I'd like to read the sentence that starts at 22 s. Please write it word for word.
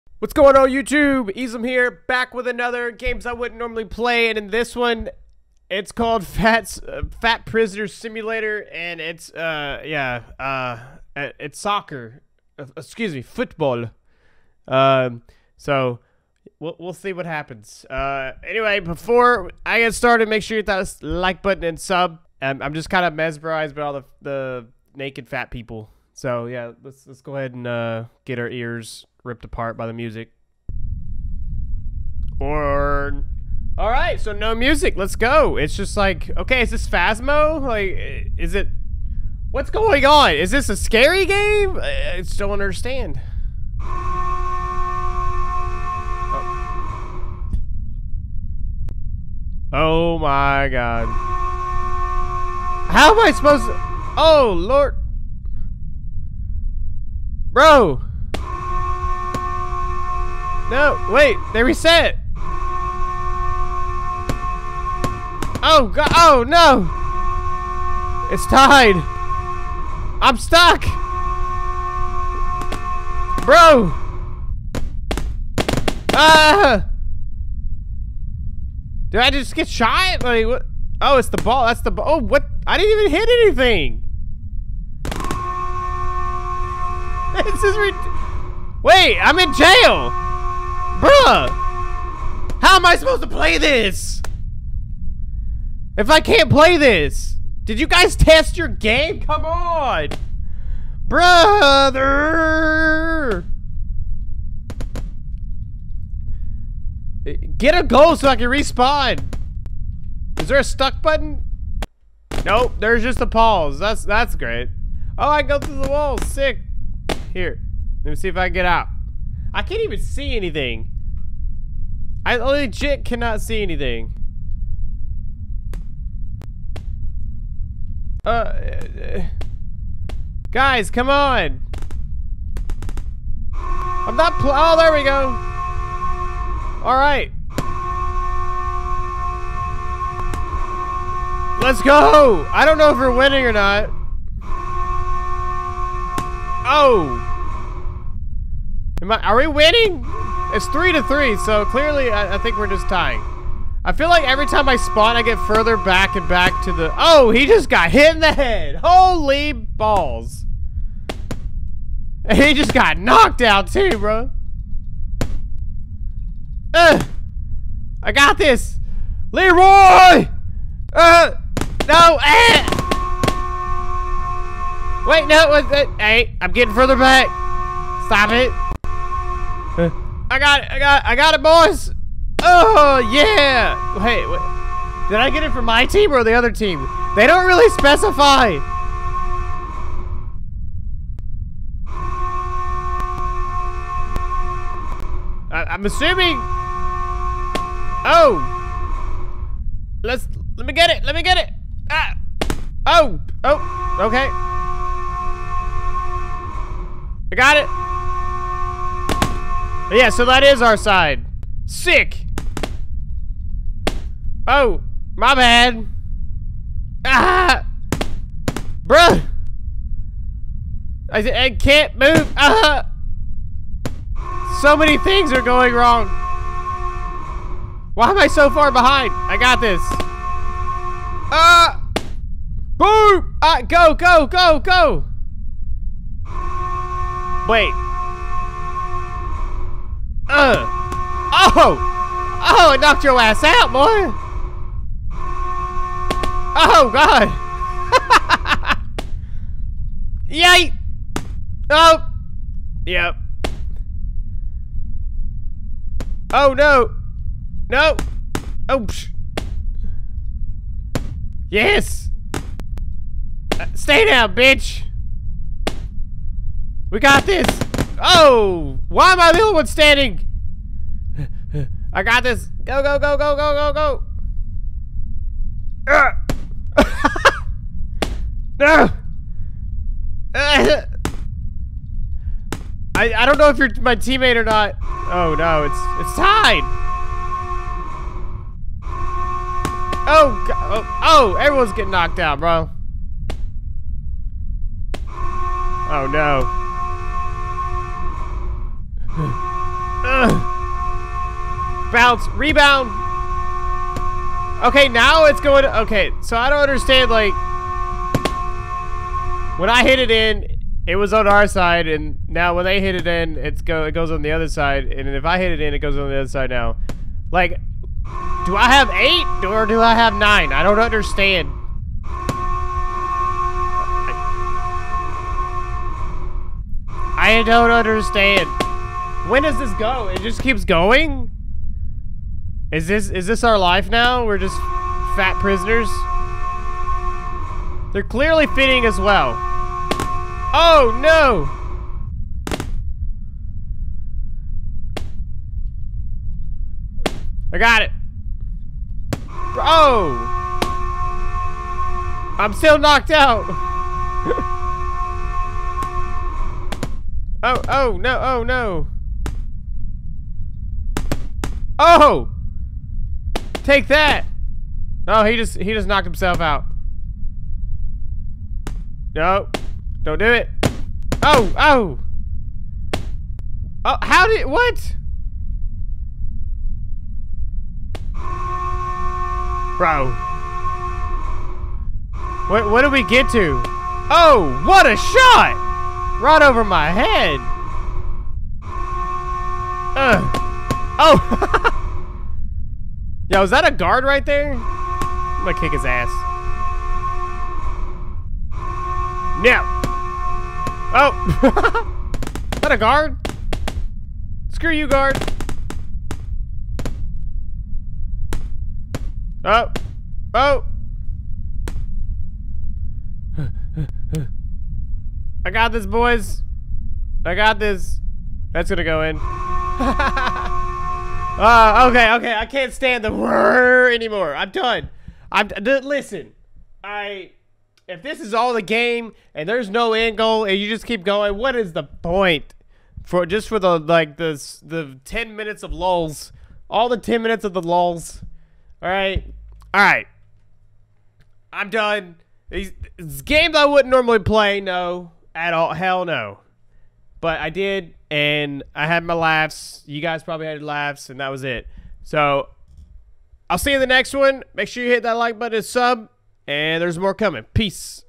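Um, I'm just kind of mesmerized by all the, the naked fat people.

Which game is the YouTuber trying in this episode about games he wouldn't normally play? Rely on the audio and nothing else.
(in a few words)
Fat Prisoner Simulator.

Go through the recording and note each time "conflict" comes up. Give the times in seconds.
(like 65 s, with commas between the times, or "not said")
not said.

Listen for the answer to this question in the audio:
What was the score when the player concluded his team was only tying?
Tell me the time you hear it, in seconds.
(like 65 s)
150 s.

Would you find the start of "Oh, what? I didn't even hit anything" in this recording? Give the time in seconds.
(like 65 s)
82 s.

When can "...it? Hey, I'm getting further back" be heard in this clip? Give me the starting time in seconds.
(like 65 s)
175 s.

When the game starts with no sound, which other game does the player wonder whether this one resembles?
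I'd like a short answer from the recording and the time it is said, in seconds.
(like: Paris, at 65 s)
Phasmo, at 36 s.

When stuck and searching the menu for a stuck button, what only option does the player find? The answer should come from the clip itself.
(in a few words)
a pause.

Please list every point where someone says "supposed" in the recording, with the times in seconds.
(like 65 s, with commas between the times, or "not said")
53 s, 92 s.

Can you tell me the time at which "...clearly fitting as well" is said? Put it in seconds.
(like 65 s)
338 s.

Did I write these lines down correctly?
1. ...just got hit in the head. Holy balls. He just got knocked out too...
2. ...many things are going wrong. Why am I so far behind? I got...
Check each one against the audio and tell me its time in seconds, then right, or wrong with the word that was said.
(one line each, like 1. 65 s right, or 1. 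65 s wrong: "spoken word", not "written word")
1. 157 s right
2. 224 s right.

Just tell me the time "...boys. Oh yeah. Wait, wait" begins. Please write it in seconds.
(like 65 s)
181 s.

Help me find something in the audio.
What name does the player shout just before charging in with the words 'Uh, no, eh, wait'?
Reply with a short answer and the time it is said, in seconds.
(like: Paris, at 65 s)
Leroy, at 169 s.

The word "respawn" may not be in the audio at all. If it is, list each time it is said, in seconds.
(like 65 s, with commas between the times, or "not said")
108 s.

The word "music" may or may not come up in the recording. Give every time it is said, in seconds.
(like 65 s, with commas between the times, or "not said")
29 s, 34 s.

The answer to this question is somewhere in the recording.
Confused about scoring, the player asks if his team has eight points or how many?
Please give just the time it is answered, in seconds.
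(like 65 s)
320 s.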